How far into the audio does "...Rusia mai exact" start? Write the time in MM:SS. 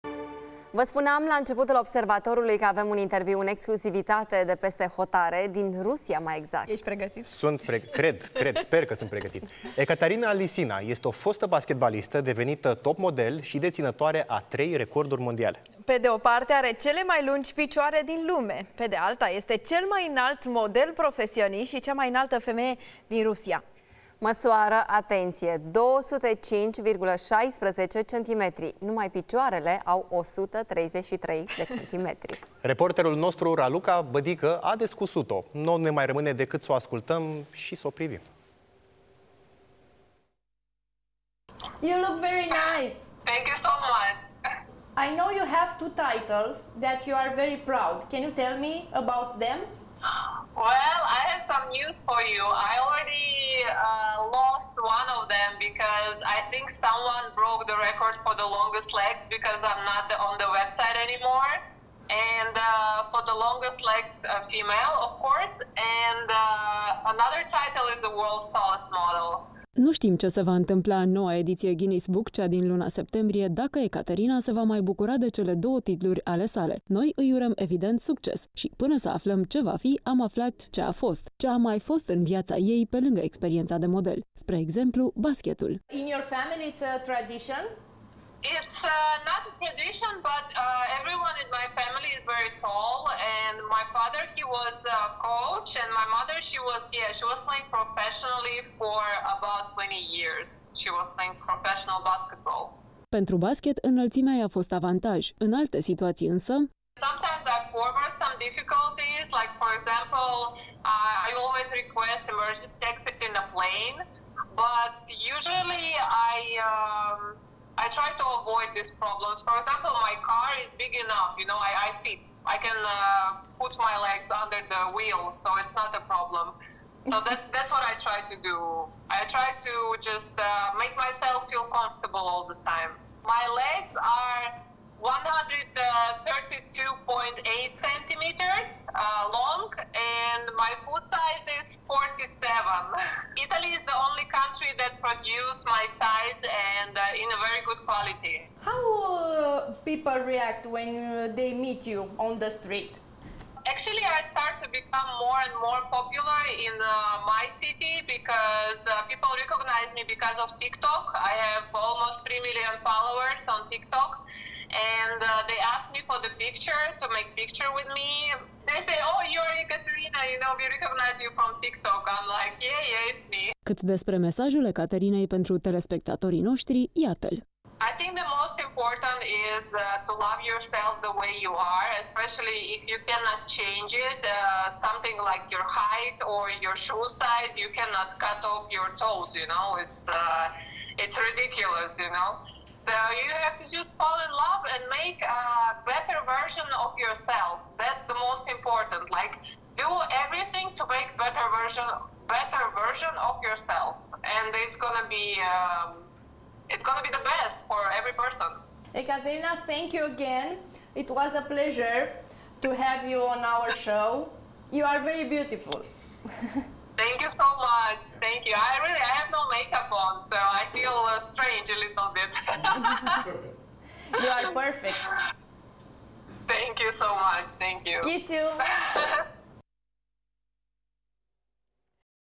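00:05.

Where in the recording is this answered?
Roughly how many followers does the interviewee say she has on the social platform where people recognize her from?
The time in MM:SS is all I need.
02:41.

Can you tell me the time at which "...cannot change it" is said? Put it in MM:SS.
03:03.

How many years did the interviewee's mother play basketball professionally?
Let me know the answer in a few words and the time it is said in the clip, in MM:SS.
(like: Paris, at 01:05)
20 years, at 01:39.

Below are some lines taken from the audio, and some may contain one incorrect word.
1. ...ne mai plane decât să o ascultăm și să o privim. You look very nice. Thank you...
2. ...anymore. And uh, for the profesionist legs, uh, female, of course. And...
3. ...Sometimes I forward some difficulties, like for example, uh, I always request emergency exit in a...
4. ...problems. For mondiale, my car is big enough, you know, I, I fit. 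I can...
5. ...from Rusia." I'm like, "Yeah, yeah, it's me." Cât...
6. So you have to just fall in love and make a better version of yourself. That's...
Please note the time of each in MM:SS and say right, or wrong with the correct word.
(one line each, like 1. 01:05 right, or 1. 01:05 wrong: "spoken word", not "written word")
1. 00:35 wrong: "rămâne", not "plane"
2. 01:01 wrong: "longest", not "profesionist"
3. 01:47 right
4. 01:59 wrong: "example", not "mondiale"
5. 02:51 wrong: "TikTok", not "Rusia"
6. 03:12 right.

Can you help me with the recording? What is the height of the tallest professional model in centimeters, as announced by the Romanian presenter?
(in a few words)
205.16 cm.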